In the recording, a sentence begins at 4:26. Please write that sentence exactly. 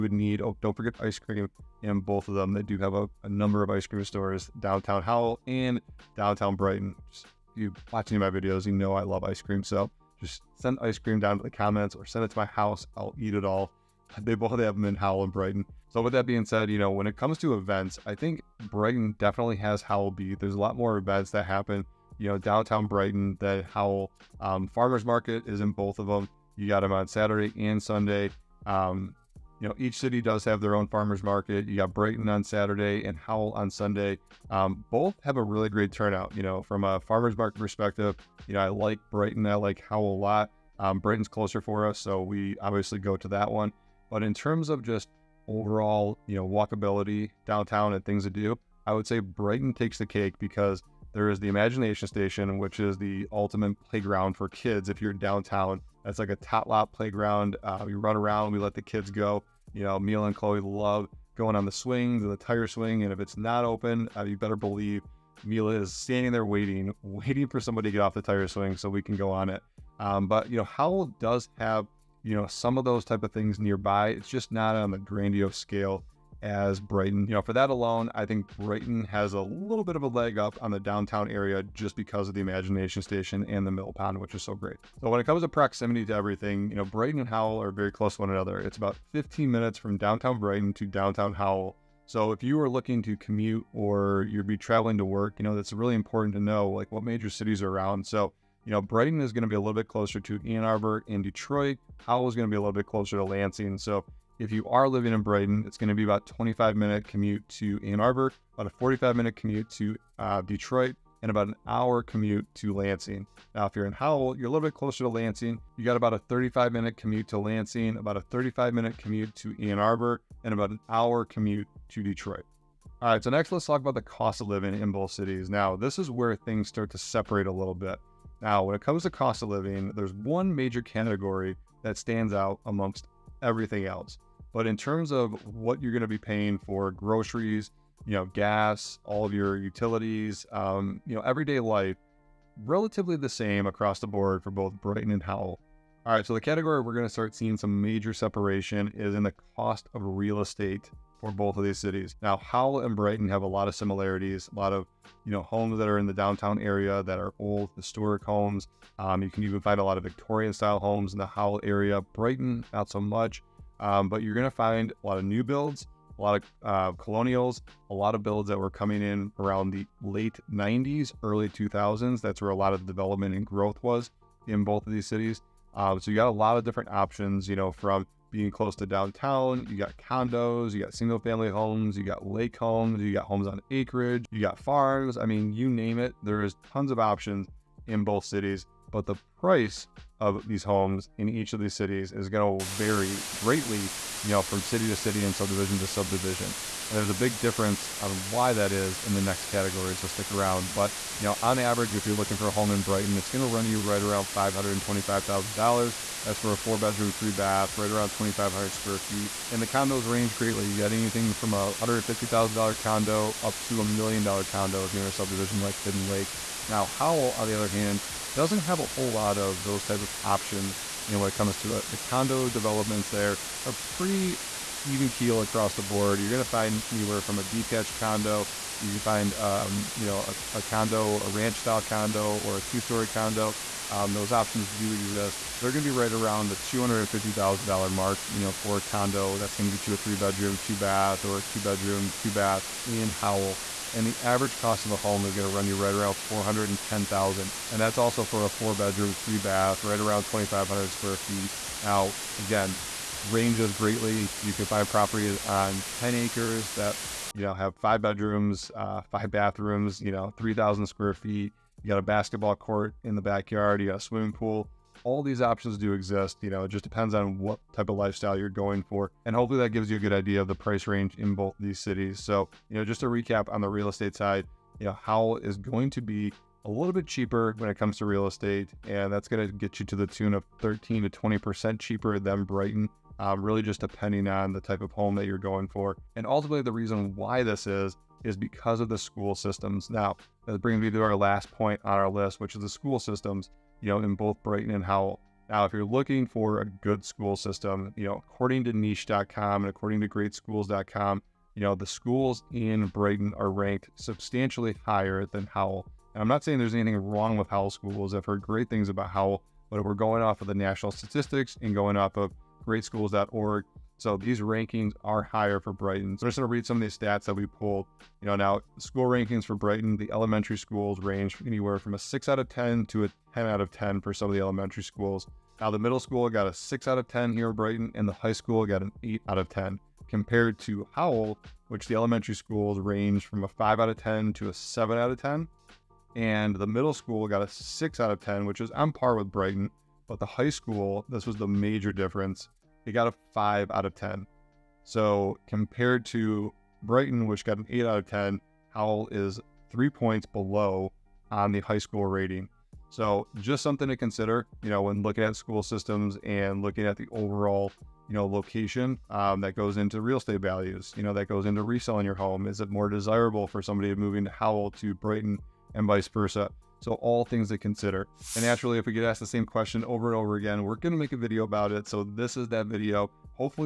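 You know, it just depends on what type of lifestyle you're going for.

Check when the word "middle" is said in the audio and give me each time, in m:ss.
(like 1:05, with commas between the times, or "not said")
5:25, 5:36.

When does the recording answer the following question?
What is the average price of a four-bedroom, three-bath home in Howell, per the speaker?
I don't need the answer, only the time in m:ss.
4:06.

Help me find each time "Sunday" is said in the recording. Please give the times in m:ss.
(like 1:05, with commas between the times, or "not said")
0:27, 0:33.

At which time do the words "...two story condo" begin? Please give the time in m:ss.
3:52.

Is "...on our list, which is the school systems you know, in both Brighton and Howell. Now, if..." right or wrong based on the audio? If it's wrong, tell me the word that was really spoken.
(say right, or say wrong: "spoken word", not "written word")
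right.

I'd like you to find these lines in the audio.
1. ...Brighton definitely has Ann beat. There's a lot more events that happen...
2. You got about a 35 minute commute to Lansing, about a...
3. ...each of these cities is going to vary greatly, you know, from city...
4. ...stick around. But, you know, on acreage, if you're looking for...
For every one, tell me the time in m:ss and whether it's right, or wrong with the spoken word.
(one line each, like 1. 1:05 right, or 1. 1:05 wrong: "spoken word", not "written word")
1. 0:18 wrong: "Howell", not "Ann"
2. 1:55 right
3. 3:11 right
4. 3:20 wrong: "average", not "acreage".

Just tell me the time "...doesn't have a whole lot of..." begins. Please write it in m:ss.
3:38.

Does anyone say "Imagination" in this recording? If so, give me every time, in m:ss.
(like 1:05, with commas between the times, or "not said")
0:51, 1:22.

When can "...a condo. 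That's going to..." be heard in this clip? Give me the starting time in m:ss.
3:58.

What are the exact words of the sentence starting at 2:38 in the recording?
Um, you can even find a lot of Victorian style homes in the Howell area.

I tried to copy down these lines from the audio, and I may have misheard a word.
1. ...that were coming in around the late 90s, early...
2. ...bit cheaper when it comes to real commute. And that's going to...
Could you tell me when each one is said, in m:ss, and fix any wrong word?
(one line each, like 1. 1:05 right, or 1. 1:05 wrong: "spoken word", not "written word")
1. 2:48 right
2. 4:36 wrong: "estate", not "commute".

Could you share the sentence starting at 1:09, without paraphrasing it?
Um, but you know, Howell does have you know some of those type of things nearby.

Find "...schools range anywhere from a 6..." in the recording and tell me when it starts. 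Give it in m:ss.
5:20.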